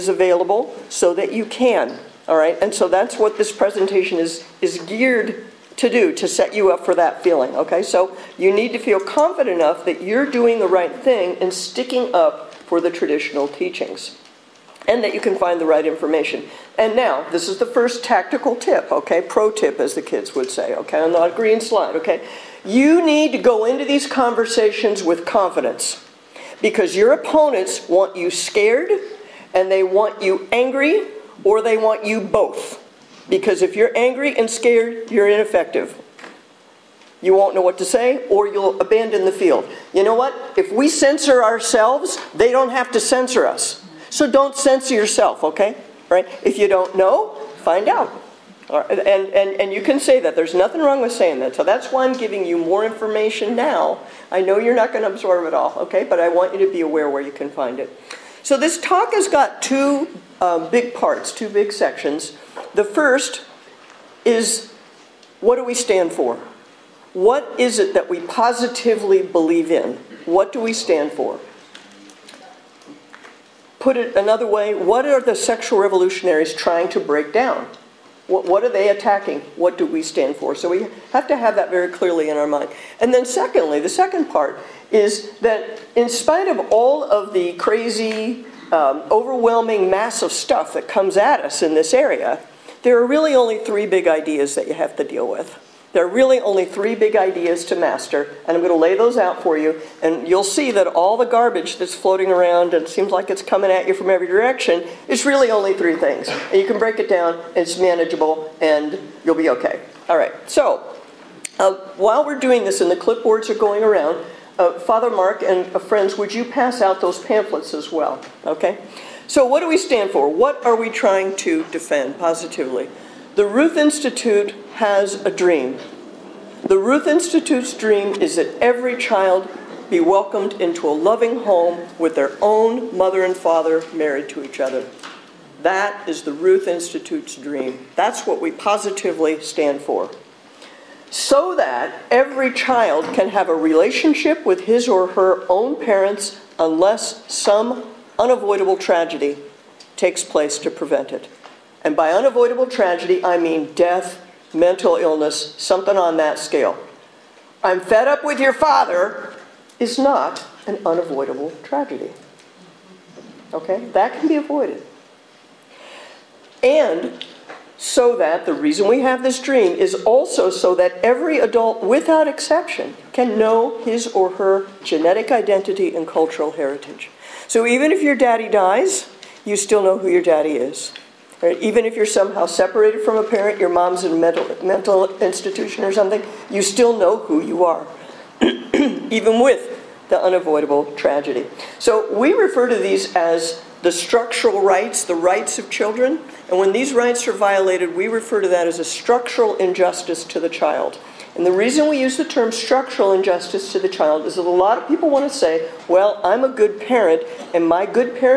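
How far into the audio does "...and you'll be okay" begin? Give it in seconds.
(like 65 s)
108 s.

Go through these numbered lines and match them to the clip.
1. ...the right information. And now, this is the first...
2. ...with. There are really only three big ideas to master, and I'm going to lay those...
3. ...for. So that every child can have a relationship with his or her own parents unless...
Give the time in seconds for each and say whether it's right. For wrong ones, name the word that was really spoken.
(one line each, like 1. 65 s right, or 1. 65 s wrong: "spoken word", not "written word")
1. 15 s right
2. 95 s right
3. 139 s right.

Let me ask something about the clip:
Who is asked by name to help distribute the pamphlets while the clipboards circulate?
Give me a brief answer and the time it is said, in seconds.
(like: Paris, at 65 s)
Father Mark, at 114 s.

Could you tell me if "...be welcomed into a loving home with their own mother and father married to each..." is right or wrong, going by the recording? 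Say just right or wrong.
right.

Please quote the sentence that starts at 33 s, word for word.
Because if you're angry and scared, you're ineffective.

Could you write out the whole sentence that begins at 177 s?
So even if your daddy dies, you still know who your daddy is.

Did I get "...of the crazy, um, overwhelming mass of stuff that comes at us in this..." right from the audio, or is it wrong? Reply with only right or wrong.
right.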